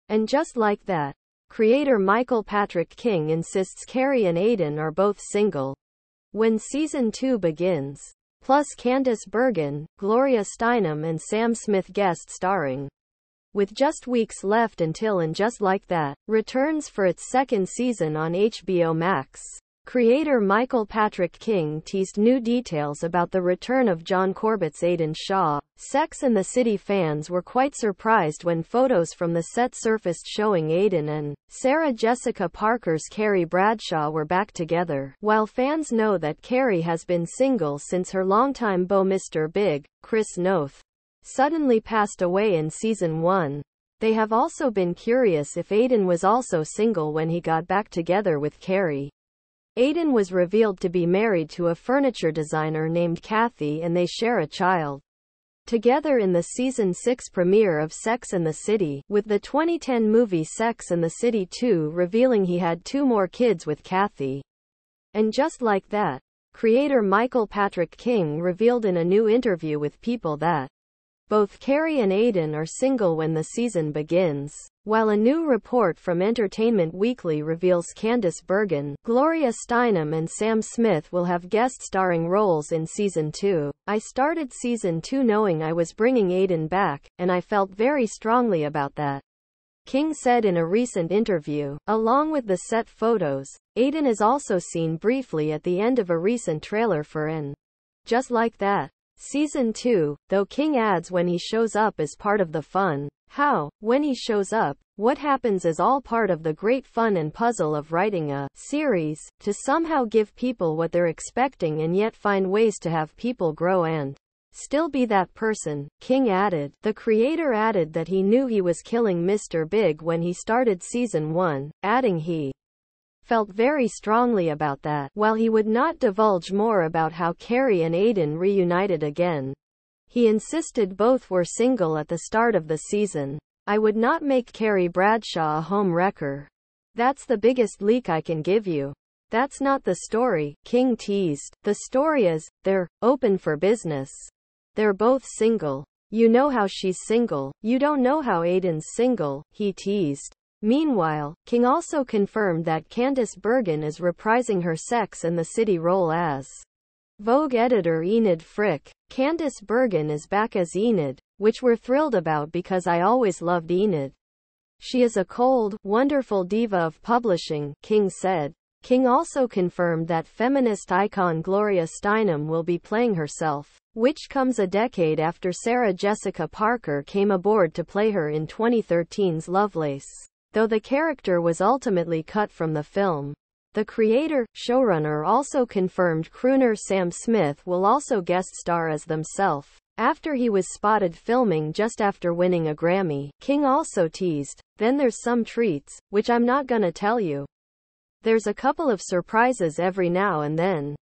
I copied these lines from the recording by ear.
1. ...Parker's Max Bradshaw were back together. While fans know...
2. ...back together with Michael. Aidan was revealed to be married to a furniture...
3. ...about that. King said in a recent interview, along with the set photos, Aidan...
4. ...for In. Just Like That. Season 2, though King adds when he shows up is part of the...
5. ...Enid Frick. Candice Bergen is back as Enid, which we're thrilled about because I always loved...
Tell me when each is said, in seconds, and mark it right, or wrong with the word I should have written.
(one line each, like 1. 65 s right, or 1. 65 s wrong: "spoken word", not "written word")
1. 32 s wrong: "Carrie", not "Max"
2. 47 s wrong: "Carrie", not "Michael"
3. 88 s right
4. 97 s right
5. 158 s right.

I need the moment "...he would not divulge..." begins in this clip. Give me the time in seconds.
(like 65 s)
125 s.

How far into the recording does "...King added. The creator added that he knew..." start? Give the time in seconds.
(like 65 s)
115 s.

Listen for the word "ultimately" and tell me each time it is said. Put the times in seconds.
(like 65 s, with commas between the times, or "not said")
181 s.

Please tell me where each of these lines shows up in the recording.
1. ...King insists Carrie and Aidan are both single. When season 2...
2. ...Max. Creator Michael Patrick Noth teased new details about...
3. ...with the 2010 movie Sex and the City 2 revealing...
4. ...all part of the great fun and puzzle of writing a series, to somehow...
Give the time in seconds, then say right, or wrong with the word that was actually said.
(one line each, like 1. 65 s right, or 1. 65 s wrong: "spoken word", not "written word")
1. 2 s right
2. 18 s wrong: "King", not "Noth"
3. 59 s right
4. 105 s right.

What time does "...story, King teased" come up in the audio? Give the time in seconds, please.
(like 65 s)
140 s.